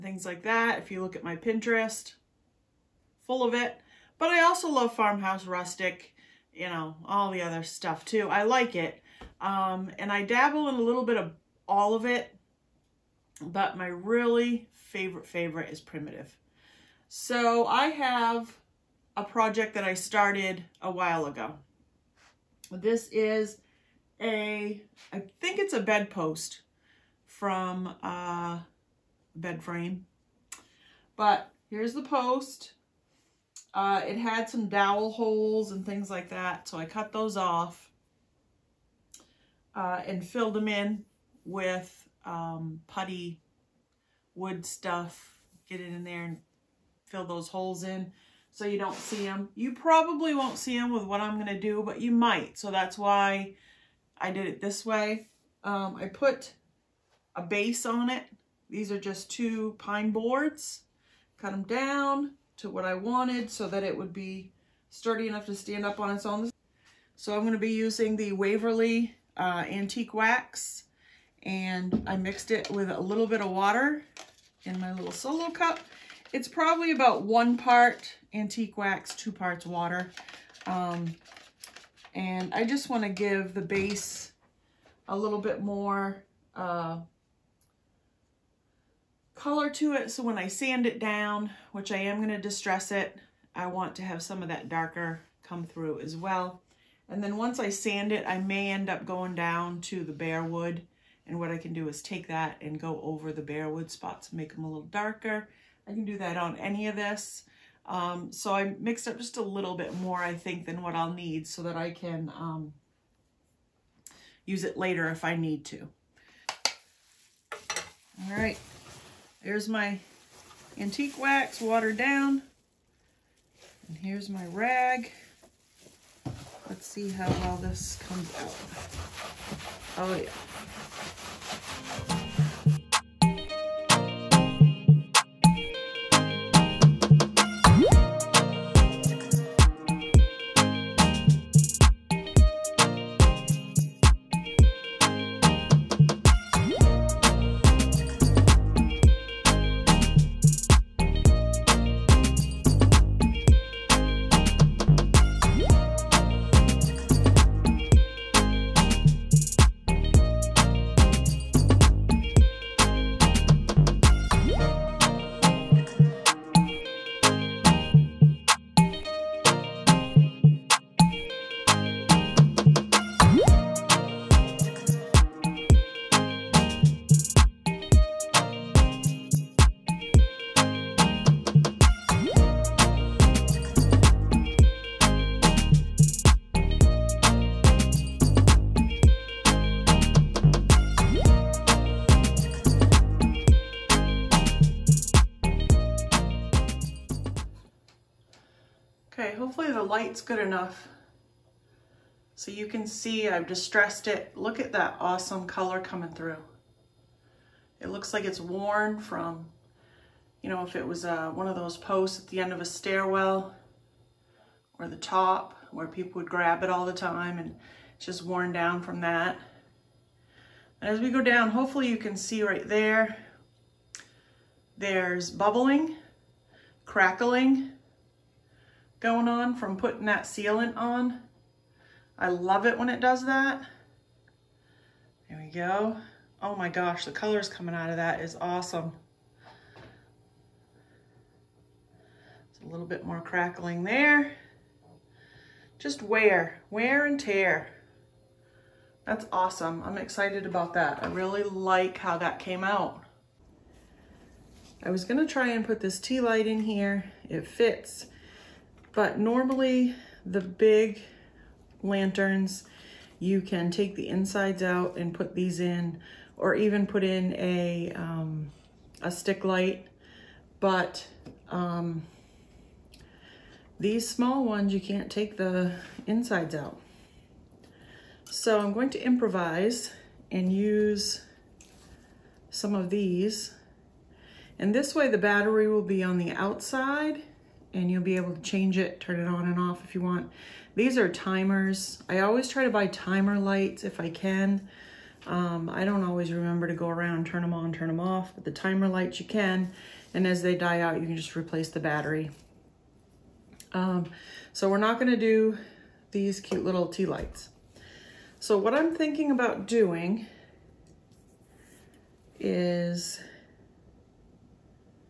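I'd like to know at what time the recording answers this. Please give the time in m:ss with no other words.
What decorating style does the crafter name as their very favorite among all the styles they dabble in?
0:15.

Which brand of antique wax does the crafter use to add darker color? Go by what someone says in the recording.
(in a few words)
Waverly.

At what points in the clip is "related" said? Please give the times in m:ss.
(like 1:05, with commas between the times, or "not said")
not said.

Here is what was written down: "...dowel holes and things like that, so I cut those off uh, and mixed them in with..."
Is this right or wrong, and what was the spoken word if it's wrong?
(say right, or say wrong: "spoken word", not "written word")
wrong: "filled", not "mixed".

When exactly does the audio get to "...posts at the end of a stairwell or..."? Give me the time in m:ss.
3:31.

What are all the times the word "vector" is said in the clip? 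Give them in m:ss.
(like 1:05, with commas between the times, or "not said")
not said.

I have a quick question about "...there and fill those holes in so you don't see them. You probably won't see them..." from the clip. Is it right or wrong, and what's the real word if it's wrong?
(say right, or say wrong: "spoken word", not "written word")
right.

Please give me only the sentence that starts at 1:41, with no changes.
And what I can do is take that and go over the bare wood spots and make them a little darker.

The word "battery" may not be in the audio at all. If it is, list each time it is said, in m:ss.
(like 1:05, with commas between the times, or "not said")
4:45, 5:01.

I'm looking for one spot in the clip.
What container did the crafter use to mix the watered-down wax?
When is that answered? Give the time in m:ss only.
1:15.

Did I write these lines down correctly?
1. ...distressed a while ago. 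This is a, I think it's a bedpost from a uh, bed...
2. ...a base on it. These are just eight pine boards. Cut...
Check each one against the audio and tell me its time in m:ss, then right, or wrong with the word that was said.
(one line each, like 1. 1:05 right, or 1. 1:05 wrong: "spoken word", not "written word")
1. 0:19 wrong: "started", not "distressed"
2. 0:57 wrong: "two", not "eight".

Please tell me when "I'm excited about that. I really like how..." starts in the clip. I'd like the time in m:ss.
4:09.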